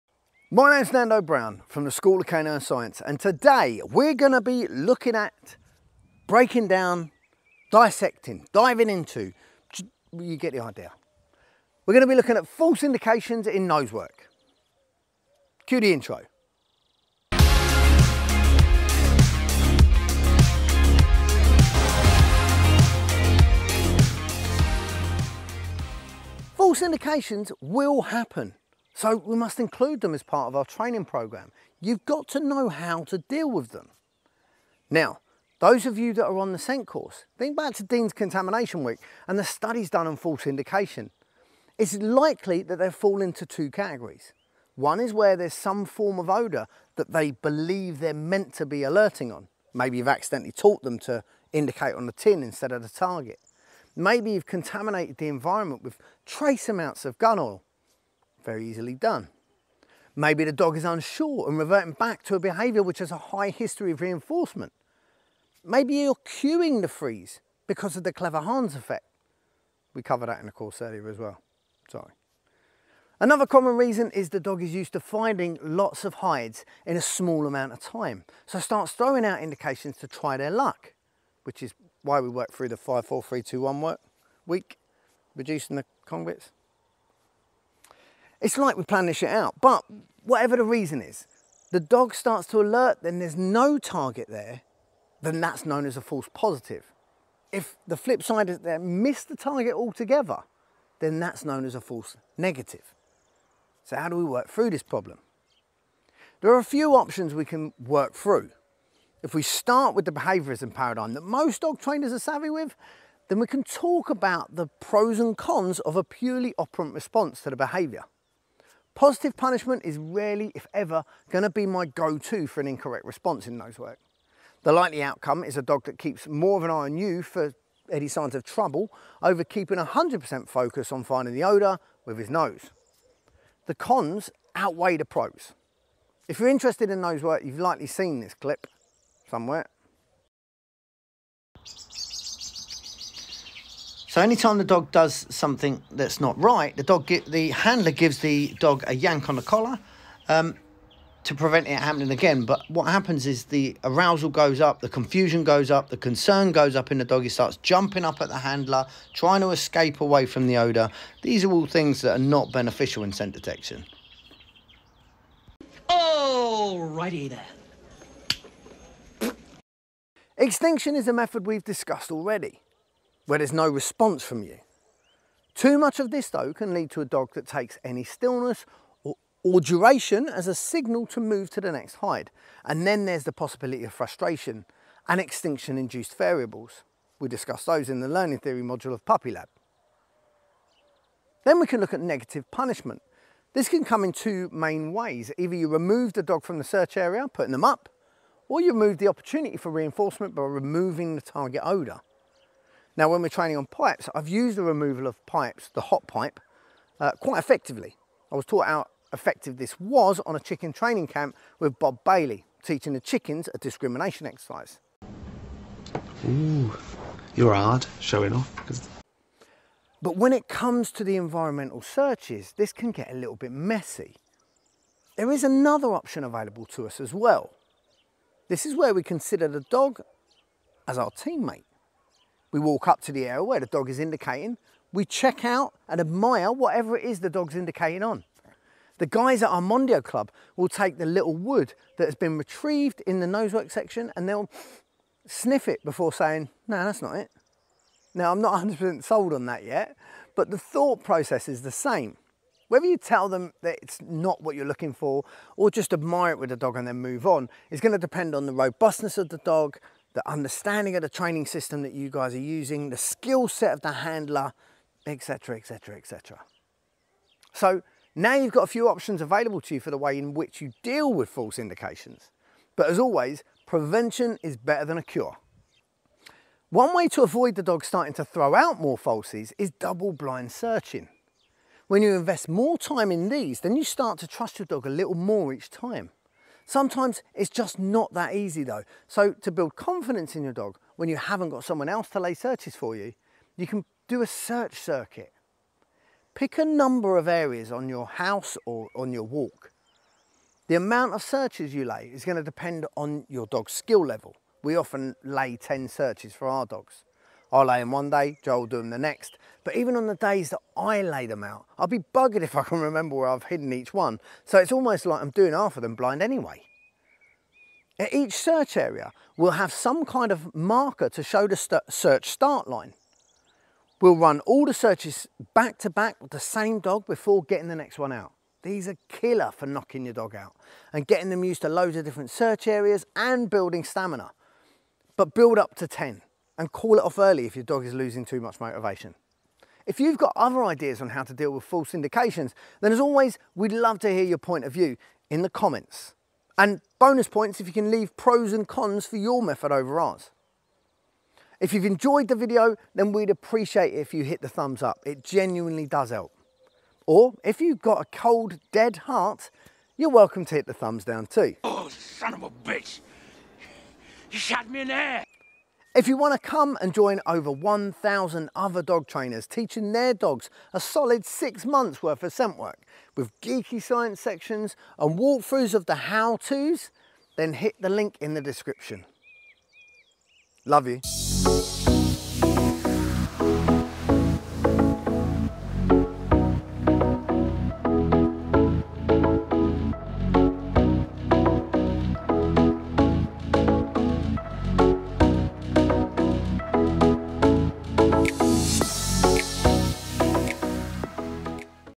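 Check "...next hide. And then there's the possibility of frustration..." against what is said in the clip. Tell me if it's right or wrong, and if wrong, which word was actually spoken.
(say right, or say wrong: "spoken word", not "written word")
right.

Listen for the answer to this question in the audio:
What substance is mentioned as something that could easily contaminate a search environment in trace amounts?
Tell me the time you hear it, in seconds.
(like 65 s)
57 s.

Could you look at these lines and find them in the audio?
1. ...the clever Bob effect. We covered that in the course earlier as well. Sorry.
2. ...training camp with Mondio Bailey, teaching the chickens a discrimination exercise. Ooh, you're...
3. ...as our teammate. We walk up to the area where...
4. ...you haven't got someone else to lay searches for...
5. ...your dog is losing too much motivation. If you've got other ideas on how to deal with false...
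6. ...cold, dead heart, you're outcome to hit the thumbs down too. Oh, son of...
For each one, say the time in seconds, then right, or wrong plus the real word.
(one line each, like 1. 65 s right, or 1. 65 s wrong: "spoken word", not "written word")
1. 68 s wrong: "Hans", not "Bob"
2. 210 s wrong: "Bob", not "Mondio"
3. 230 s right
4. 291 s right
5. 337 s right
6. 358 s wrong: "welcome", not "outcome".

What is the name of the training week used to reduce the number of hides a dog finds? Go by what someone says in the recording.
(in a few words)
5-4-3-2-1 work week.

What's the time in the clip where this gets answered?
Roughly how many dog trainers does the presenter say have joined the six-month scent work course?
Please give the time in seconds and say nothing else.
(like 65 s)
367 s.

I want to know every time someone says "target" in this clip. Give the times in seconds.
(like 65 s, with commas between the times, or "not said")
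52 s, 93 s, 99 s, 201 s.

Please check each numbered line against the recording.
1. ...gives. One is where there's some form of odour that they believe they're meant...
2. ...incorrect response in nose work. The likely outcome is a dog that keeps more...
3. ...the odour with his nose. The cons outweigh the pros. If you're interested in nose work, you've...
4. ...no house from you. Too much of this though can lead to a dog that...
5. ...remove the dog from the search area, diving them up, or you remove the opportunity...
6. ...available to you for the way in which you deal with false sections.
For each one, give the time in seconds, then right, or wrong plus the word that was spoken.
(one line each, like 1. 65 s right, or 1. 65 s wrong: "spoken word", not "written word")
1. 43 s wrong: "categories", not "gives"
2. 122 s right
3. 131 s right
4. 173 s wrong: "response", not "house"
5. 195 s wrong: "putting", not "diving"
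6. 269 s wrong: "indications", not "sections".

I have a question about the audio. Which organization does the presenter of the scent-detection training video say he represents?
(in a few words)
School of Canine Science.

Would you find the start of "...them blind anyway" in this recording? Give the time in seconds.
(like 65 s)
315 s.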